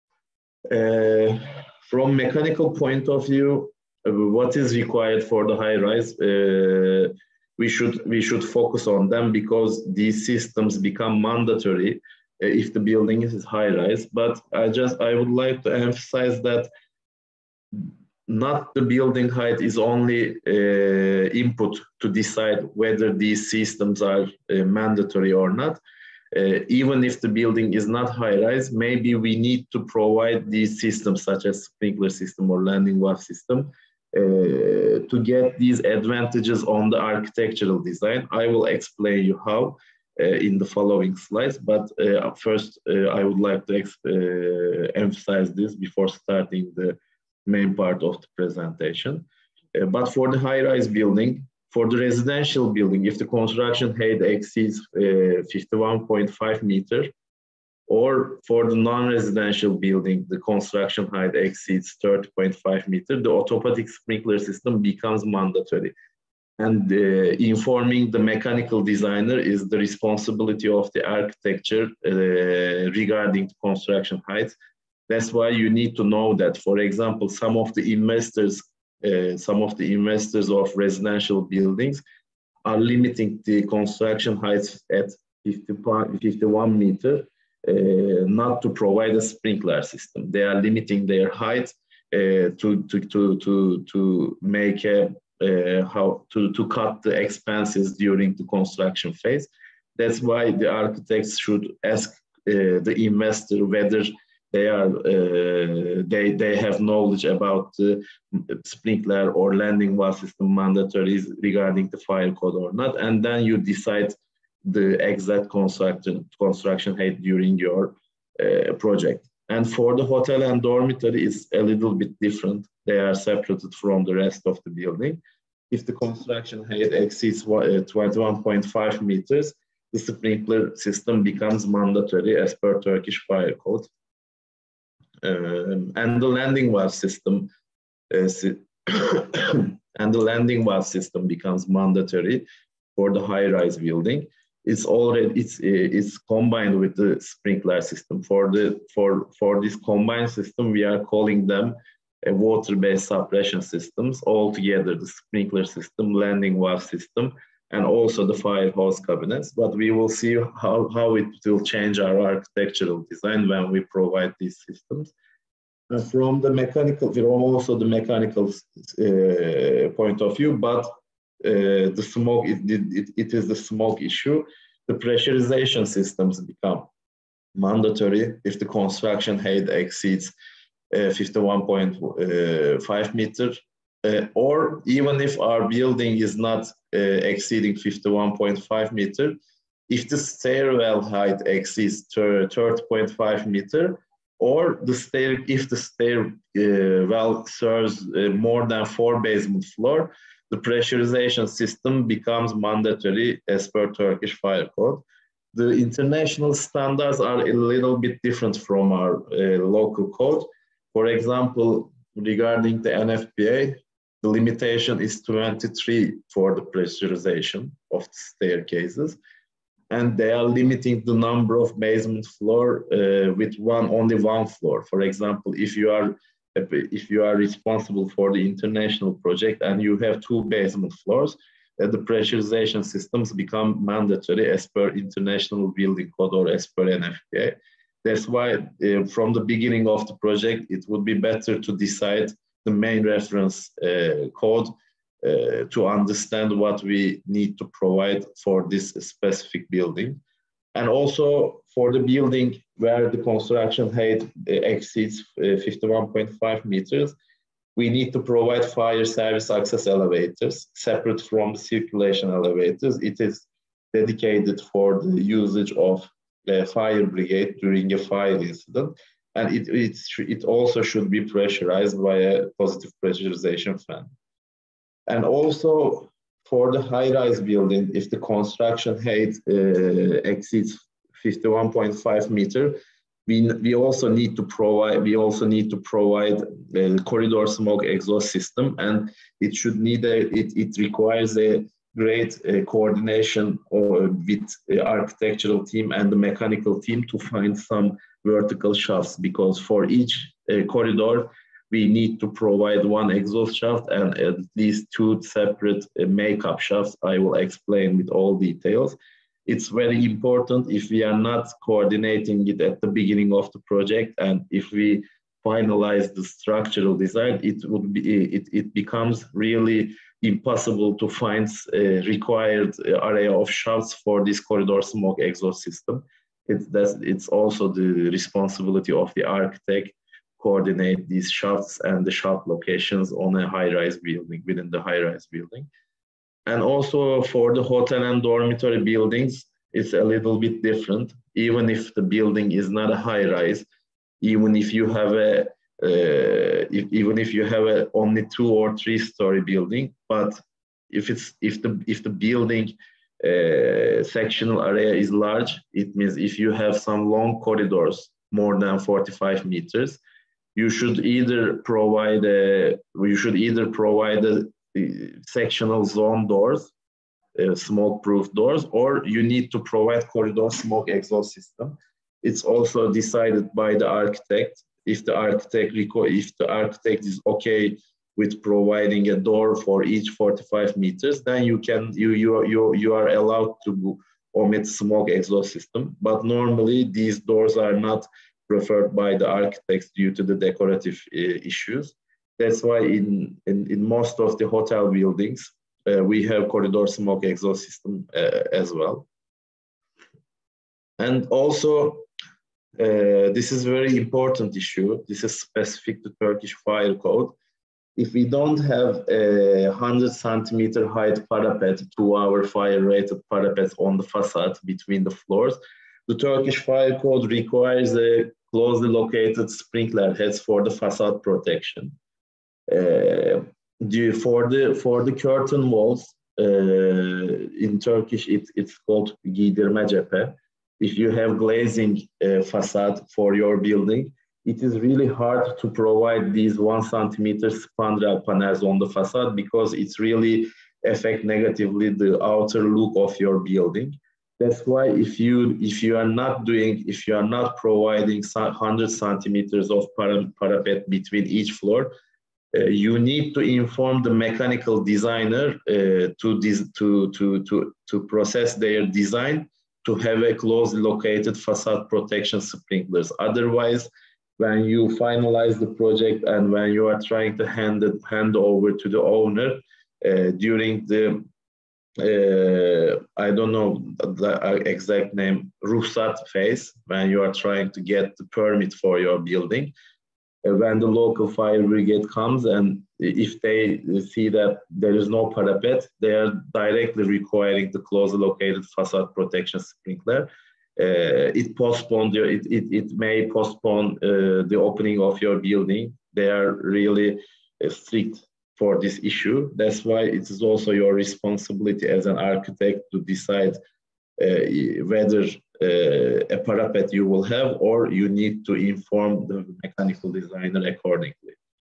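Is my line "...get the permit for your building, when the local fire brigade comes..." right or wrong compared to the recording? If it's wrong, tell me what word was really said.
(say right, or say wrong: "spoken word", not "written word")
right.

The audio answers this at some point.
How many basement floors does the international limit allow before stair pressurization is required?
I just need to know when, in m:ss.
3:43.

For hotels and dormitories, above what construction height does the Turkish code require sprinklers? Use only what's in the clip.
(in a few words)
21.5 meters.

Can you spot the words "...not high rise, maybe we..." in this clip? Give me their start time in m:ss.
0:27.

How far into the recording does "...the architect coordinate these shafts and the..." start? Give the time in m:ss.
5:29.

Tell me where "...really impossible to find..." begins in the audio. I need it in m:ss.
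5:19.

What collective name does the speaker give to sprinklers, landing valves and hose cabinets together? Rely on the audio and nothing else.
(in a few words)
water-based suppression systems.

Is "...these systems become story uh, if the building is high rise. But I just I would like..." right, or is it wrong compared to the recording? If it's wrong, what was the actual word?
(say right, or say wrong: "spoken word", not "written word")
wrong: "mandatory", not "story".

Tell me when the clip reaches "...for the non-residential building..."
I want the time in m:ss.
0:58.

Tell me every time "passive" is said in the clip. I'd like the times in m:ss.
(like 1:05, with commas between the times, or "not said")
not said.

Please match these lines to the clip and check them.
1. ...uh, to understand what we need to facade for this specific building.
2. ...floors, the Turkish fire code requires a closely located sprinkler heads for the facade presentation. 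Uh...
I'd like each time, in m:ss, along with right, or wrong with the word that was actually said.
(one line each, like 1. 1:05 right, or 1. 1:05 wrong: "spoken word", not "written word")
1. 4:05 wrong: "provide", not "facade"
2. 6:55 wrong: "protection", not "presentation".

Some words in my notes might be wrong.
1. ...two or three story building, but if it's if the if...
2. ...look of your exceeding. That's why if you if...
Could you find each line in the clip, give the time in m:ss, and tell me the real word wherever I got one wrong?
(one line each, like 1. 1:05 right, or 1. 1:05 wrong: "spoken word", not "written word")
1. 5:48 right
2. 7:22 wrong: "building", not "exceeding".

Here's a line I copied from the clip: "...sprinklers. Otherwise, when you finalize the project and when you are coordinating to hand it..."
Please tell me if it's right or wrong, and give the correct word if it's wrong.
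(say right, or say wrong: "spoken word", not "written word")
wrong: "trying", not "coordinating".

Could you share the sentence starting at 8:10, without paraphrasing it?
Uh, it postponed your, it, it, it may postpone uh, the opening of your building.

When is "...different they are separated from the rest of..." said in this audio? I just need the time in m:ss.
2:02.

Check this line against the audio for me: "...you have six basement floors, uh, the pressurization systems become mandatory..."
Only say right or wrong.
wrong.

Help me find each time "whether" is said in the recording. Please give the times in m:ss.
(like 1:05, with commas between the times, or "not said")
0:22, 1:43, 8:24.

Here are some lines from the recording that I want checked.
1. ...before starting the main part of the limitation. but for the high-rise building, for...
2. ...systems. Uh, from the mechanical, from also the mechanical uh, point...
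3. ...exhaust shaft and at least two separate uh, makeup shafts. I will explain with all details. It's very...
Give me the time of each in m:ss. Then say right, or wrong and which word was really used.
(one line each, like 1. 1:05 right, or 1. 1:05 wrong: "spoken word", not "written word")
1. 0:45 wrong: "presentation", not "limitation"
2. 2:44 right
3. 5:03 right.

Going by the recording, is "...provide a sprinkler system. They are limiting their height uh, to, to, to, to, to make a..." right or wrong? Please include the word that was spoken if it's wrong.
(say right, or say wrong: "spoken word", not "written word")
right.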